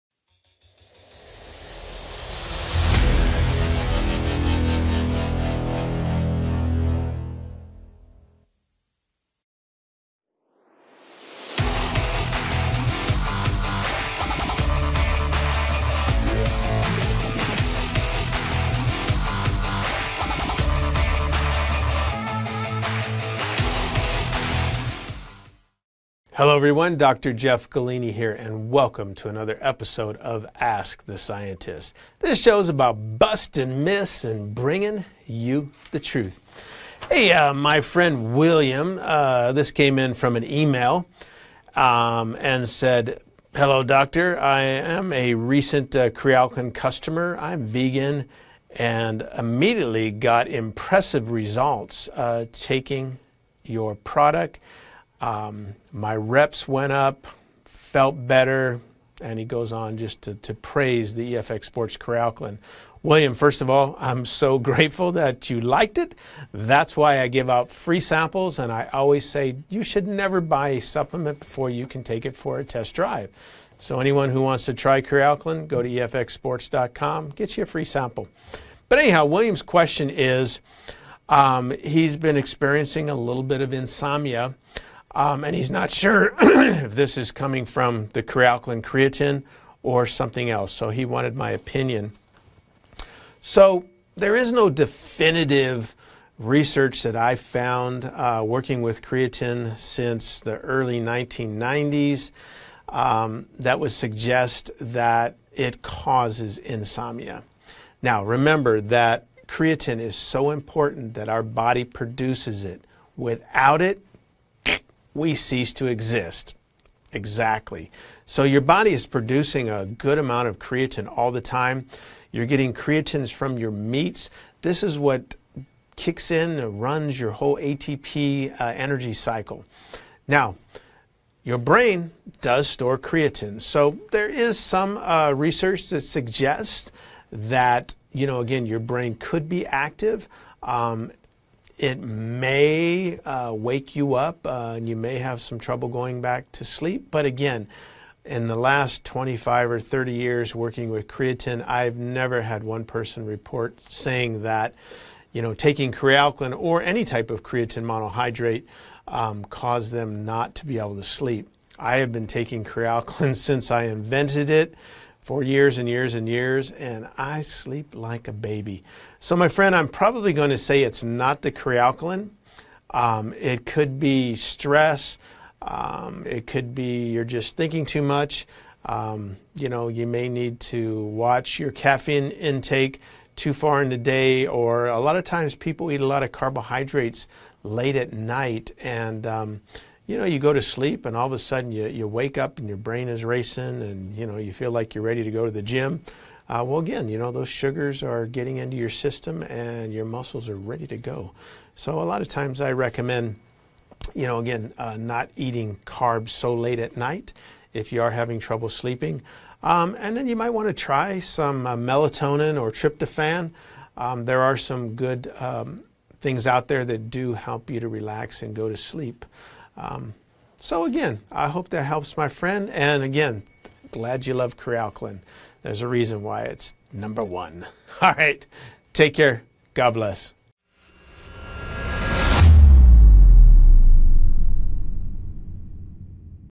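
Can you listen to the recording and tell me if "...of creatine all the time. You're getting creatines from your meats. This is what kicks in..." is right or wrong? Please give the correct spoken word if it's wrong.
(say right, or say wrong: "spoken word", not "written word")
right.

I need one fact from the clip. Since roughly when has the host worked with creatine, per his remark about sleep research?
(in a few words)
early 1990s.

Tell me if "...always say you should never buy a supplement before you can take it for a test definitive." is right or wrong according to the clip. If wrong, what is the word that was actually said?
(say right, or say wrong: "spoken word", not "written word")
wrong: "drive", not "definitive".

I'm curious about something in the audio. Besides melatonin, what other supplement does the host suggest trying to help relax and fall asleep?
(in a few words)
tryptophan.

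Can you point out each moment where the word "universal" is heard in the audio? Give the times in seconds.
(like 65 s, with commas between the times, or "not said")
not said.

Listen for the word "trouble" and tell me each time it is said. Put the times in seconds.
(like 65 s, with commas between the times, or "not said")
145 s, 208 s.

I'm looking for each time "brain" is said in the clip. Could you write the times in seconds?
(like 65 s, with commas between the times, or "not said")
131 s, 138 s, 192 s.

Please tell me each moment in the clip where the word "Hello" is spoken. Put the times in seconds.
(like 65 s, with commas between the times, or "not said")
26 s, 43 s.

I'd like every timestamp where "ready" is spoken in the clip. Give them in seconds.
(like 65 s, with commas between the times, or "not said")
195 s, 200 s.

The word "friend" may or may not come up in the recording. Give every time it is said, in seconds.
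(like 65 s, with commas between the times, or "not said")
37 s, 169 s, 222 s.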